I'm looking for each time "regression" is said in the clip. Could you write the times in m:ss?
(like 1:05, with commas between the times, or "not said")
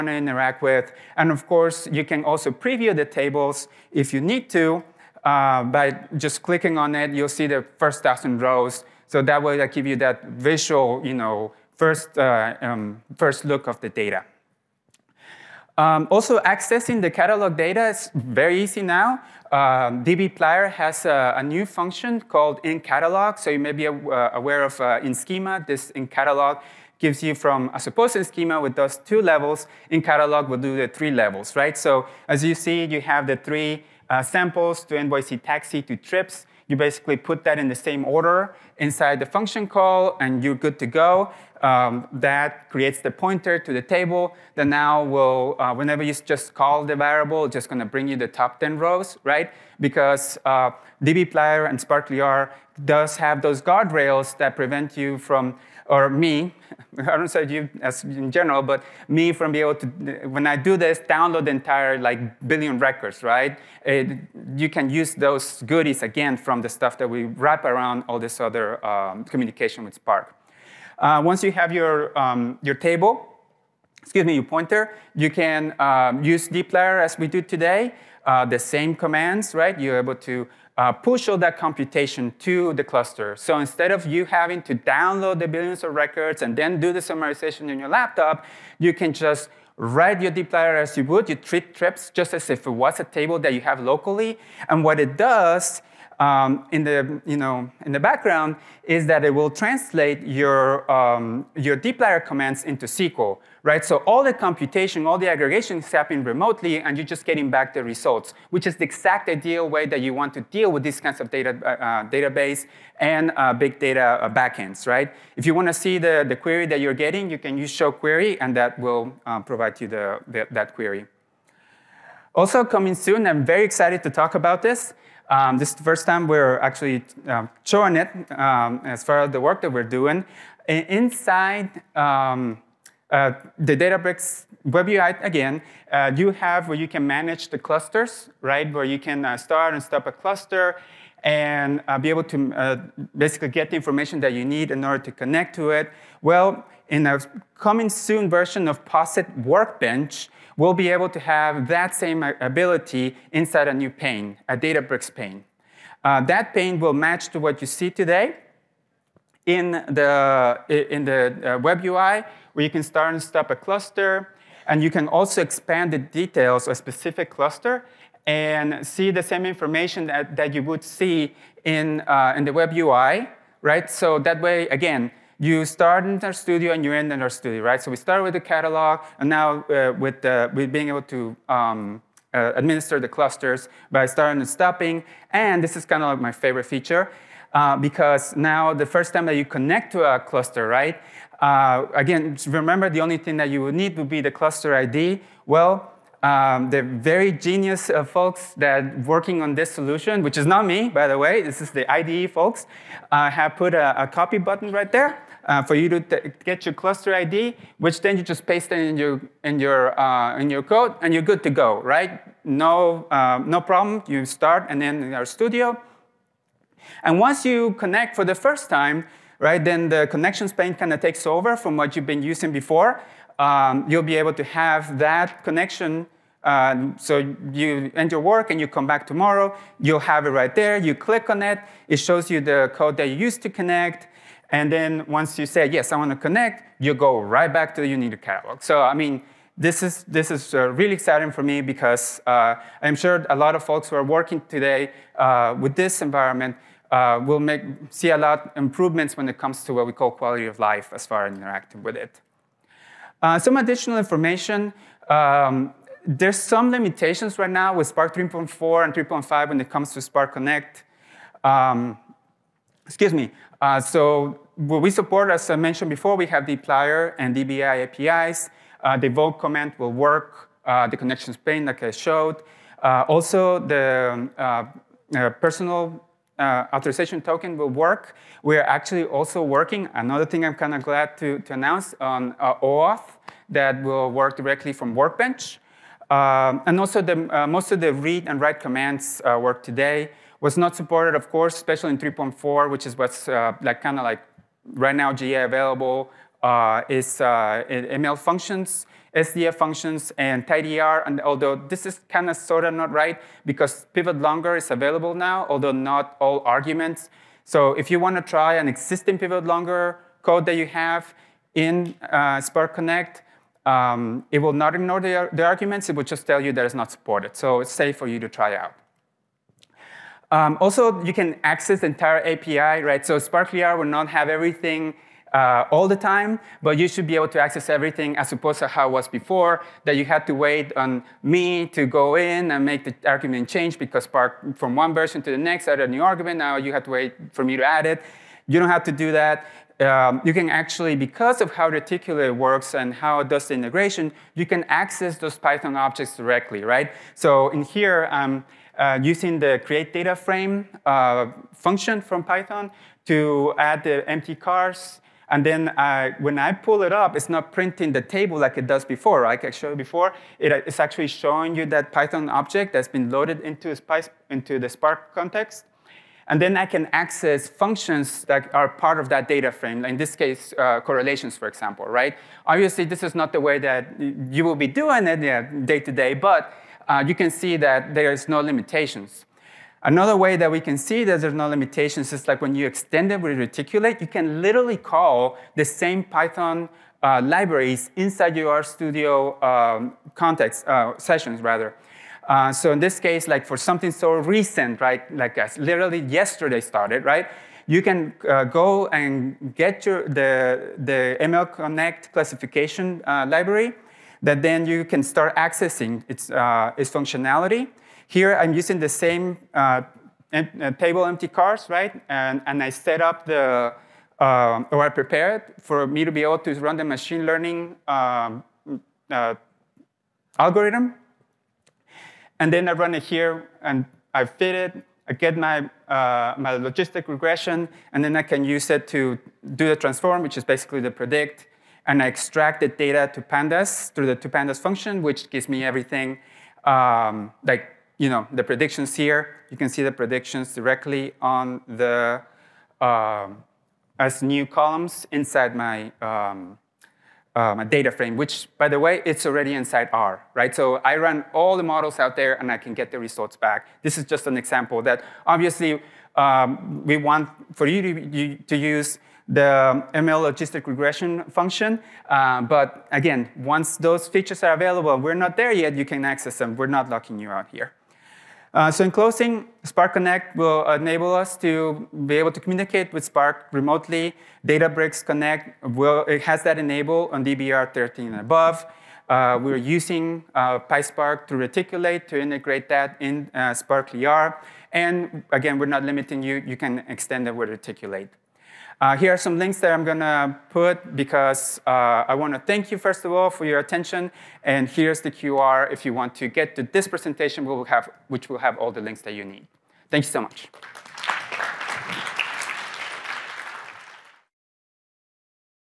7:07, 7:40.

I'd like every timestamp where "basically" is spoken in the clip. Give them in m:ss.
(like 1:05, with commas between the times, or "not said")
0:36, 2:23, 7:10.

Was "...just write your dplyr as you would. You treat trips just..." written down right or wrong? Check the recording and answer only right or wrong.
right.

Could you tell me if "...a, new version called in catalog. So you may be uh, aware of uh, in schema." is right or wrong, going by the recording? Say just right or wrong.
wrong.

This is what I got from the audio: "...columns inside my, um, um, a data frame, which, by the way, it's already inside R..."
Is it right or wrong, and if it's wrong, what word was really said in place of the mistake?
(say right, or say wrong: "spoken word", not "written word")
right.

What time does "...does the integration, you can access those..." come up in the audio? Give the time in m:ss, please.
5:43.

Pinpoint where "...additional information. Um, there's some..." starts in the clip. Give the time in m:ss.
4:13.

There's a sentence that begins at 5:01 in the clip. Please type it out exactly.
And although this is kind of sort of not right because pivot longer is available now, although not all arguments.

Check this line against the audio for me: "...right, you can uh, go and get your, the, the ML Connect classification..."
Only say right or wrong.
right.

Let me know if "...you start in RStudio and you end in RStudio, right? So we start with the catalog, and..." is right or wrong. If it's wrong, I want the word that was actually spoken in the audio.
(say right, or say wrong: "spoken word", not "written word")
right.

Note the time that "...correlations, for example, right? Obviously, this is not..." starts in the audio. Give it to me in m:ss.
6:10.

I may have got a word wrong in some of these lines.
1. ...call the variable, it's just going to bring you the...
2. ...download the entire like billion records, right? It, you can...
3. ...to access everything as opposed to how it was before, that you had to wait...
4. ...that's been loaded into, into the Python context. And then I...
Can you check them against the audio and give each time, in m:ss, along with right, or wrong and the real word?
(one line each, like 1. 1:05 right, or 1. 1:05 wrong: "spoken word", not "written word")
1. 0:46 right
2. 1:01 right
3. 5:27 right
4. 6:02 wrong: "Spark", not "Python".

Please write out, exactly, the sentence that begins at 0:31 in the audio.
So as you see, you have the three uh, samples to NYC taxi to trips.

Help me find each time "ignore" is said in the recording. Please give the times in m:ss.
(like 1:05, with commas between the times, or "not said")
5:14.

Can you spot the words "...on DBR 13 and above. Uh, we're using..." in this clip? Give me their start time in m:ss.
7:57.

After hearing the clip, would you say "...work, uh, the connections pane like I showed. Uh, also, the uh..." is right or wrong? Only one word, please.
right.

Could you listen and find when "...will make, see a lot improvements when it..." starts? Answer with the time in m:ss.
4:07.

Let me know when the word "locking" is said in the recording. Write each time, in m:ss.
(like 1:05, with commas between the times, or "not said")
7:46.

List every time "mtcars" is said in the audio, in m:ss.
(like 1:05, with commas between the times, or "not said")
5:54, 6:50.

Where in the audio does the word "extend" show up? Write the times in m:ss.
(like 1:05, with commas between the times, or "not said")
6:22, 8:06.